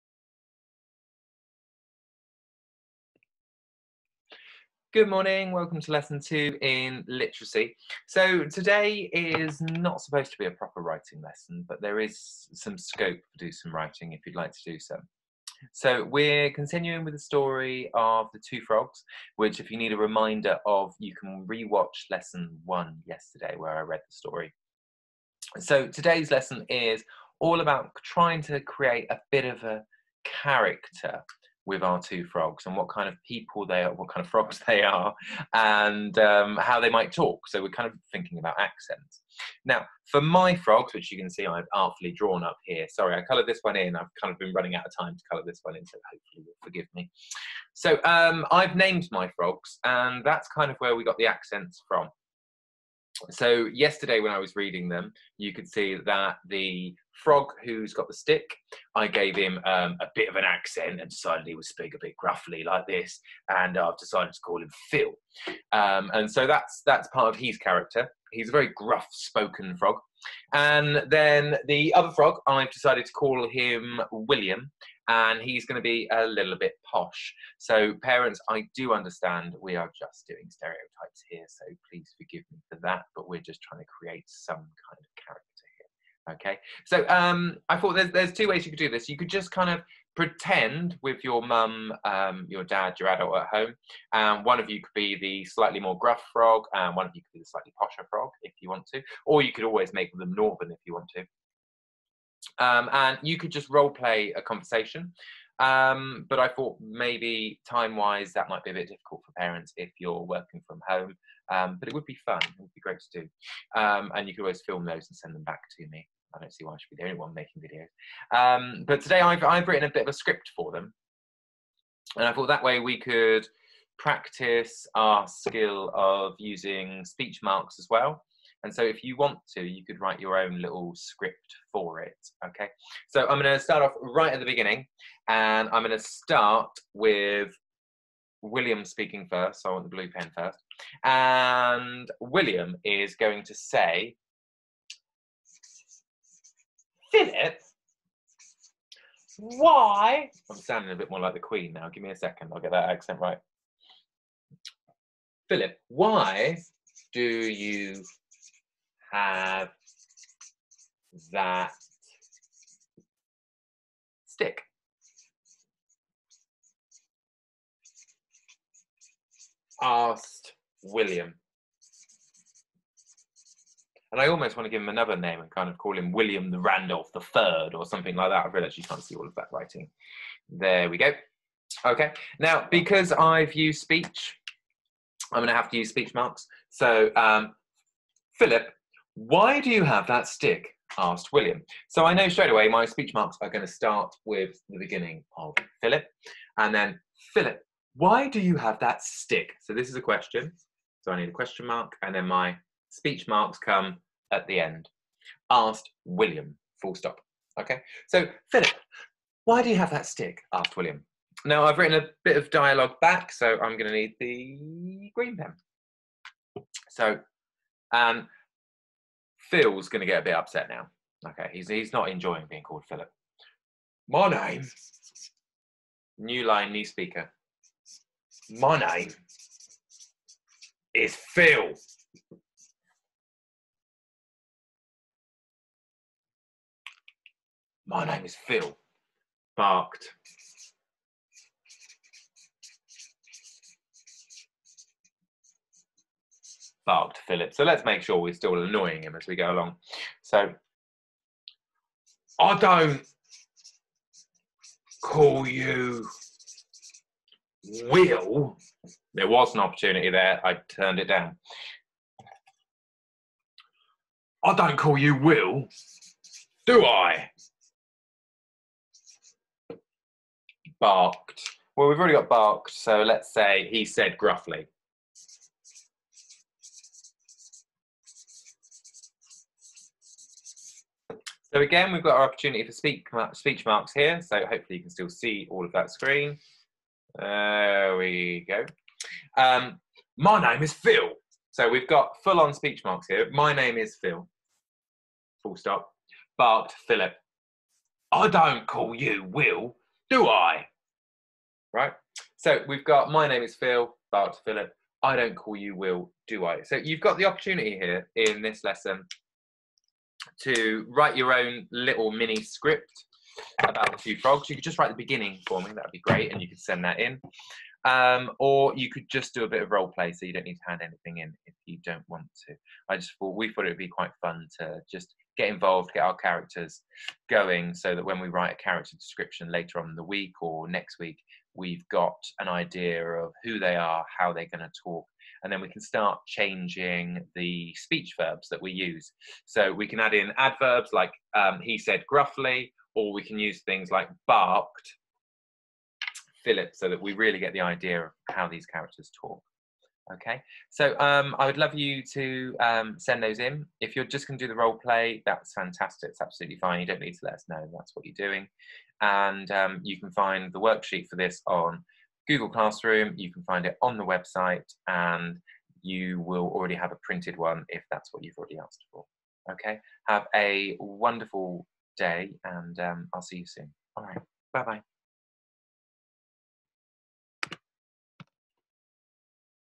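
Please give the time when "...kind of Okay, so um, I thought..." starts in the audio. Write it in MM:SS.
01:24.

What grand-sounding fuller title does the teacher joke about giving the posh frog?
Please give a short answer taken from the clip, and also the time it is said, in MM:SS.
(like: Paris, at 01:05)
William the Randolph the Third, at 02:56.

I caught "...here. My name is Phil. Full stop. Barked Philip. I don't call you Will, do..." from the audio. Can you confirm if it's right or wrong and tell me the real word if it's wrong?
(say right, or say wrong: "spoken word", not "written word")
right.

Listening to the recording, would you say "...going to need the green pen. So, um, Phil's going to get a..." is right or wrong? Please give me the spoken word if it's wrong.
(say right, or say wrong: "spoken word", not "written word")
right.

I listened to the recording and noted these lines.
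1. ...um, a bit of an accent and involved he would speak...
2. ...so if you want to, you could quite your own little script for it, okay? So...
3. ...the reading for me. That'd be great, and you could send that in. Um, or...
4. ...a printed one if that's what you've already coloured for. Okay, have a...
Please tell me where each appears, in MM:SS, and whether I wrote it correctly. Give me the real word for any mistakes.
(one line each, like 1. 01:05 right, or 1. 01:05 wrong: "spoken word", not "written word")
1. 00:59 wrong: "decided", not "involved"
2. 02:08 wrong: "write", not "quite"
3. 05:14 wrong: "beginning", not "reading"
4. 06:06 wrong: "asked", not "coloured".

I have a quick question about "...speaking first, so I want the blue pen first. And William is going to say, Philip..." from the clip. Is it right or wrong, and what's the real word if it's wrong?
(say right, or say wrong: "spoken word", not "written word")
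right.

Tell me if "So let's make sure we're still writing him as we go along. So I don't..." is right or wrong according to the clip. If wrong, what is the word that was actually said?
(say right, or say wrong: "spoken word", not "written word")
wrong: "annoying", not "writing".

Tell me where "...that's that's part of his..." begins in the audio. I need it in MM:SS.
01:06.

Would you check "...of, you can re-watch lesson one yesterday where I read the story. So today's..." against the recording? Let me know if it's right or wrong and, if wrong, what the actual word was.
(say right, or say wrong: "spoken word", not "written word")
right.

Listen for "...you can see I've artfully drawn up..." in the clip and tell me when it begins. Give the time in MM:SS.
00:41.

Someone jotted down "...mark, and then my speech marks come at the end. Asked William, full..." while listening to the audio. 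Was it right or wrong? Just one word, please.
right.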